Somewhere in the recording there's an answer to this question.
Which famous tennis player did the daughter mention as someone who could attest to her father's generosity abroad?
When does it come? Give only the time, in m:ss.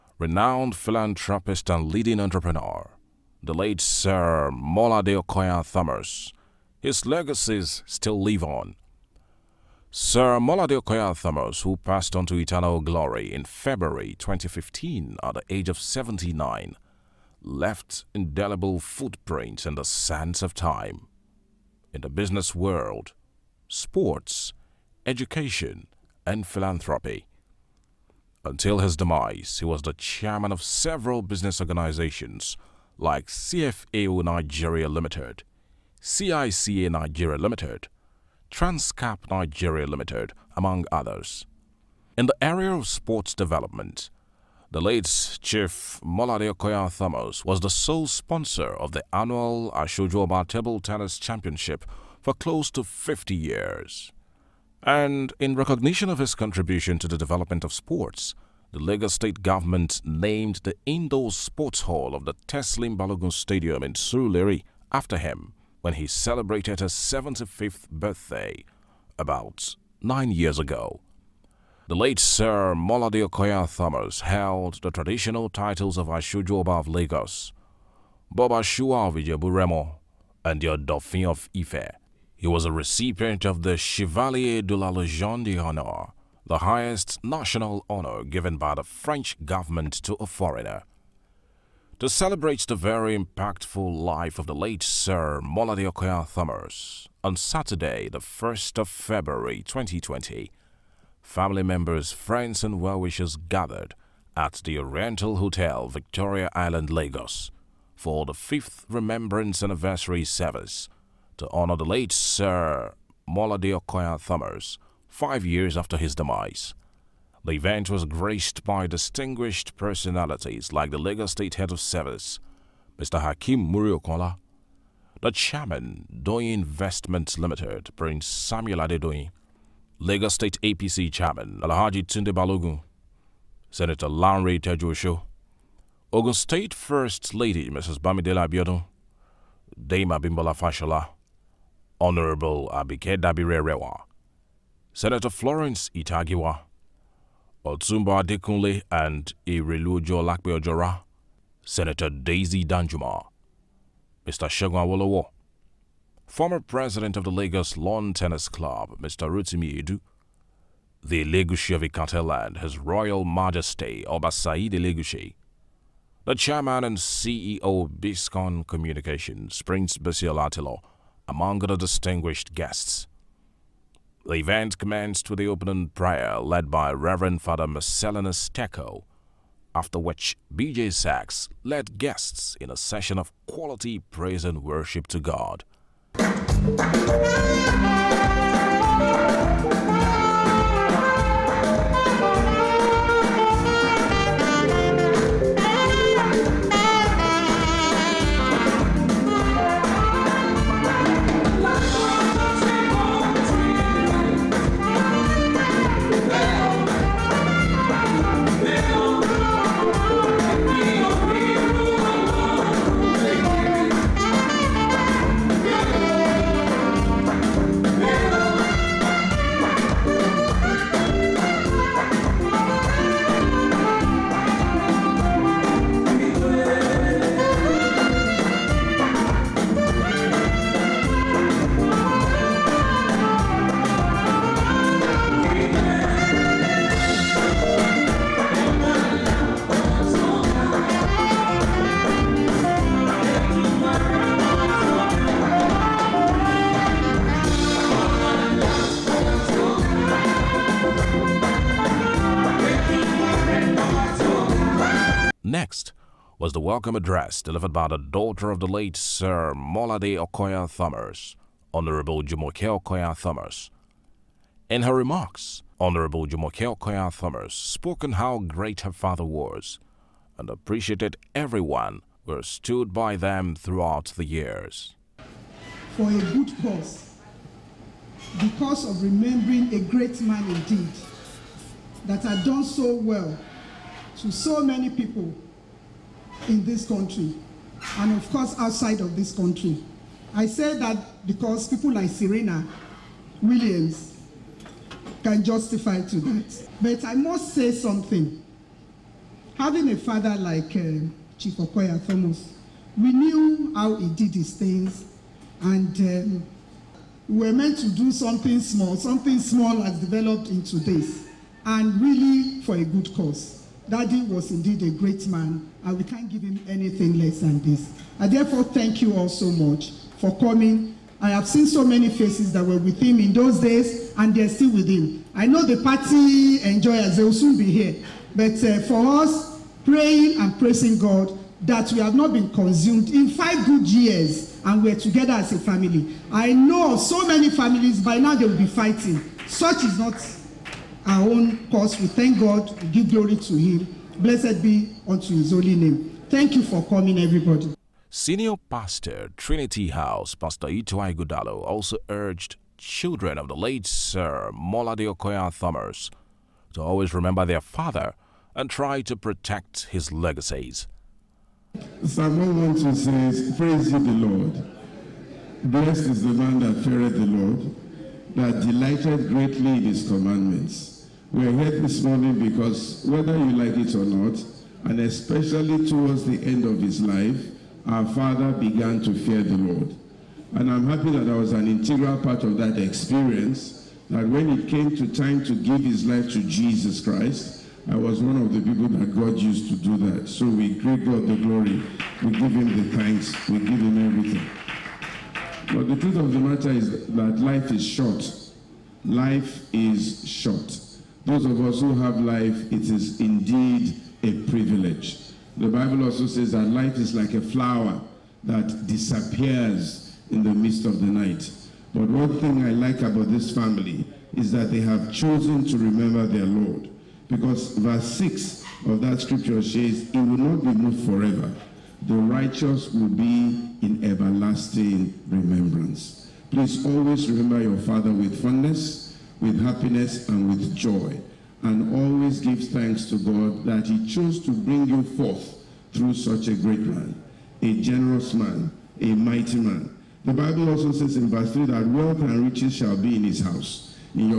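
4:52.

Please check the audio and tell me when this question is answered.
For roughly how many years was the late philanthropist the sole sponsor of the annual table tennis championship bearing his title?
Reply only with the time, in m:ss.
0:52.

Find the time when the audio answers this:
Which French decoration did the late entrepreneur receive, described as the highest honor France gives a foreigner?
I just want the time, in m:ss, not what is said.
1:23.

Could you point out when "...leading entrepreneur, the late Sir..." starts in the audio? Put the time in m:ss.
0:01.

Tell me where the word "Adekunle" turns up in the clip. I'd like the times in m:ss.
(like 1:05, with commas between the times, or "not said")
2:28.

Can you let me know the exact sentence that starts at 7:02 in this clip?
The righteous will be in everlasting remembrance.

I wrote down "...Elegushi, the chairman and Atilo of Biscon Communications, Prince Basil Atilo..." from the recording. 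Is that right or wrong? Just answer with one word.
wrong.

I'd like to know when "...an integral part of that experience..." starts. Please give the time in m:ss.
6:21.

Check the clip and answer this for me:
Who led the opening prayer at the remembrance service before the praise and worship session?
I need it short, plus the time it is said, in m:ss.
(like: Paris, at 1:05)
Reverend Father Marcellinus Teco, at 2:56.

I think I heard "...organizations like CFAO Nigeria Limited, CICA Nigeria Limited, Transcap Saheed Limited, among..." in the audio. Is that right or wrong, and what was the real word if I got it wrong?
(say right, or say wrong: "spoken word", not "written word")
wrong: "Nigeria", not "Saheed".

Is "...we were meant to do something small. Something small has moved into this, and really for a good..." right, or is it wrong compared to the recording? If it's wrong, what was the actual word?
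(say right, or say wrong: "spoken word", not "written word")
wrong: "developed", not "moved".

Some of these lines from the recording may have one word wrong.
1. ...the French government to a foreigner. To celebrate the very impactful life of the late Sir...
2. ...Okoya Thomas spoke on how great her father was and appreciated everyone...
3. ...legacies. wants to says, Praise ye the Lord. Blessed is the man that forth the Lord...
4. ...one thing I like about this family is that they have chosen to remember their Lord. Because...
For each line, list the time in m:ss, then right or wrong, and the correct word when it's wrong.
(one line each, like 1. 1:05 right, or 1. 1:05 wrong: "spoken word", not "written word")
1. 1:28 right
2. 4:26 right
3. 6:00 wrong: "feareth", not "forth"
4. 6:52 right.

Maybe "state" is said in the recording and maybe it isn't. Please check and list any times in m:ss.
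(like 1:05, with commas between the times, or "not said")
0:59, 2:01, 2:10, 2:16.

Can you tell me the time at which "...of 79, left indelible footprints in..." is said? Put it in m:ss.
0:15.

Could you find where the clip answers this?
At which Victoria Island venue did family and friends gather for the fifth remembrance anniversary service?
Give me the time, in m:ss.
1:44.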